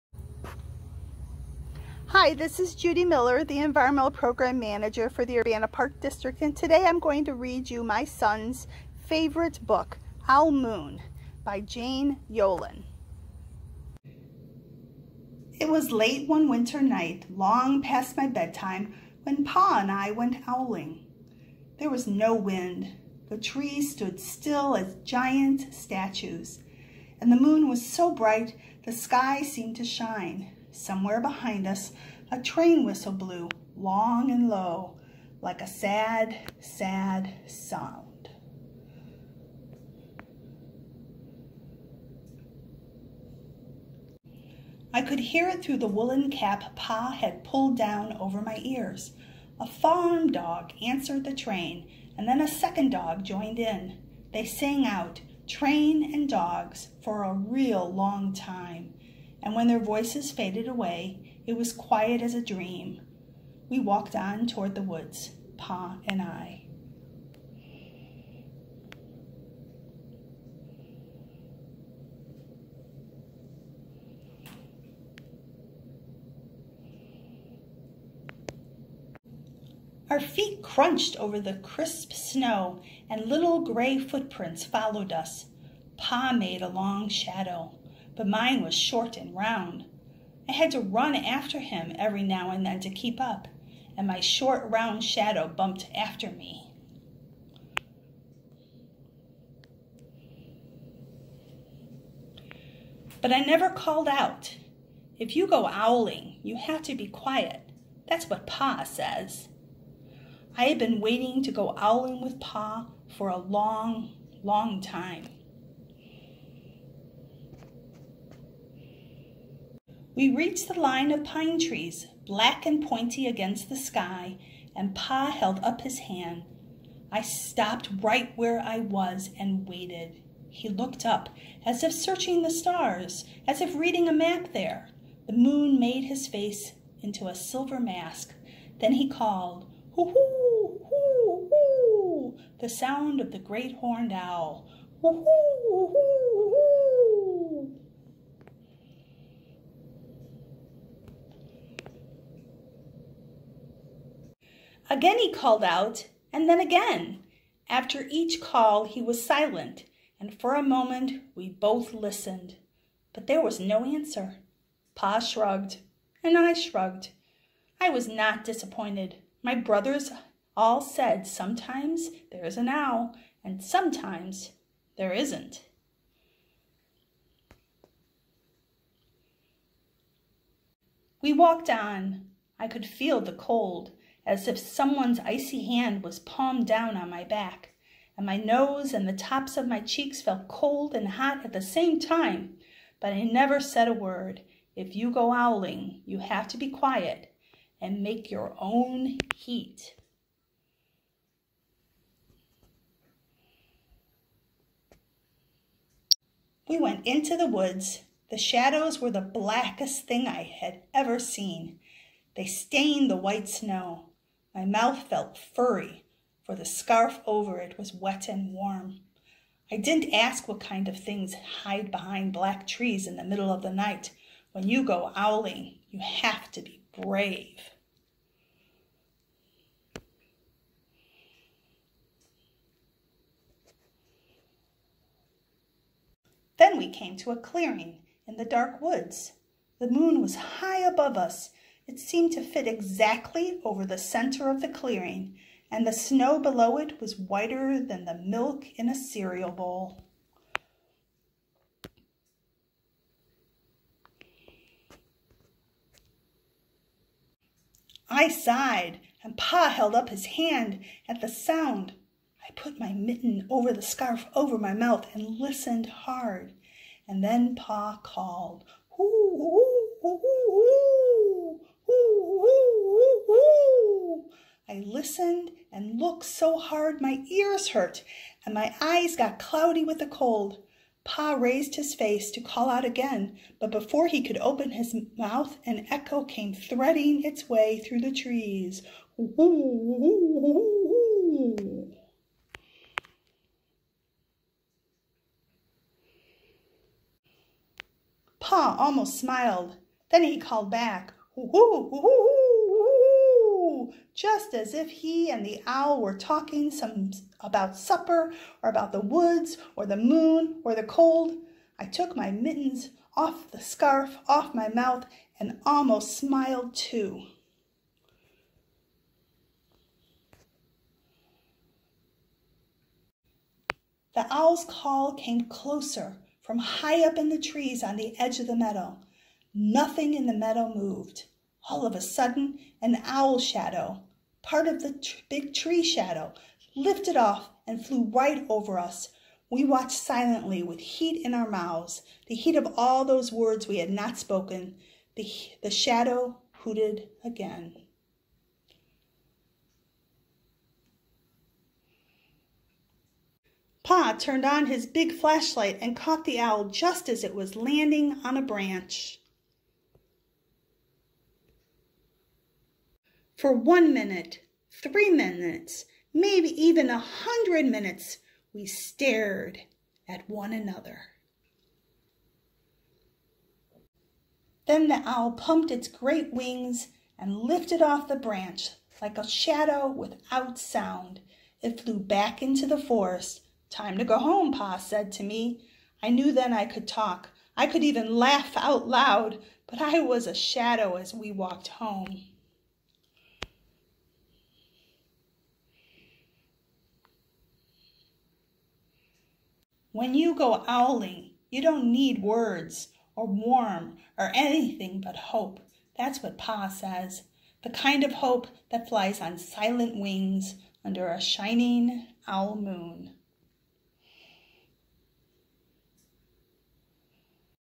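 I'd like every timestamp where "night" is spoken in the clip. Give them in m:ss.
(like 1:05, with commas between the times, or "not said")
0:16, 3:43.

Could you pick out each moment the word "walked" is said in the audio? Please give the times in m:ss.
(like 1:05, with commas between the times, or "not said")
1:03, 3:01, 6:31.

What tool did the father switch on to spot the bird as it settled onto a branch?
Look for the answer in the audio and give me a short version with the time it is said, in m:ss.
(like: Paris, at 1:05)
big flashlight, at 5:54.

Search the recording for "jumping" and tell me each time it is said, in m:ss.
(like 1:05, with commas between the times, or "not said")
not said.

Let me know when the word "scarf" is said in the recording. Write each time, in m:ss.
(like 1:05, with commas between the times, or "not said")
3:36, 4:23, 5:13.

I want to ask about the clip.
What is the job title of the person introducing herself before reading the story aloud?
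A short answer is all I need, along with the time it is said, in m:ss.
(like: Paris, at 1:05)
Environmental Program Manager, at 0:03.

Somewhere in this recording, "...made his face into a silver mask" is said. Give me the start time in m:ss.
2:15.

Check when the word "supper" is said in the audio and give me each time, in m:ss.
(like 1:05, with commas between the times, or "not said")
5:07.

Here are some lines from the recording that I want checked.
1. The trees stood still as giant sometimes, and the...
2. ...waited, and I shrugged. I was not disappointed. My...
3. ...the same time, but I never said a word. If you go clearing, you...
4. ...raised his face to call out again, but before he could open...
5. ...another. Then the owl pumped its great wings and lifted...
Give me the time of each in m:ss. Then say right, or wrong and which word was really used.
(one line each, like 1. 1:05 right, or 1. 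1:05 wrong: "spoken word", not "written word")
1. 0:23 wrong: "statues", not "sometimes"
2. 2:45 wrong: "shrugged", not "waited"
3. 3:11 wrong: "owling", not "clearing"
4. 4:41 right
5. 6:10 right.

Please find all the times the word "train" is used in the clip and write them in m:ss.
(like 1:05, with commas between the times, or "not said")
0:32, 0:51, 0:55.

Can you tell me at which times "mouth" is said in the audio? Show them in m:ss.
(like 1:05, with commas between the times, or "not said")
3:34, 4:24, 4:45, 5:14, 5:41.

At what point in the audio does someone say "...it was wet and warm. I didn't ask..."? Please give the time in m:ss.
3:37.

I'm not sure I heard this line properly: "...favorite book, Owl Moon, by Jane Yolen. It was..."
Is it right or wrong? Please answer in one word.
right.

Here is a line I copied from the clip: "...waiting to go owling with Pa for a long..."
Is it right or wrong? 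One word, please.
right.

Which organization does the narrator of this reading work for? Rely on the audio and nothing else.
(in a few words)
Urbana Park District.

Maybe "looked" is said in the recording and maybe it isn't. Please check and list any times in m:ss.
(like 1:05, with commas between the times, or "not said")
2:10, 4:35.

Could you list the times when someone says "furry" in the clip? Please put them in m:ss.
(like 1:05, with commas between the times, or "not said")
3:35.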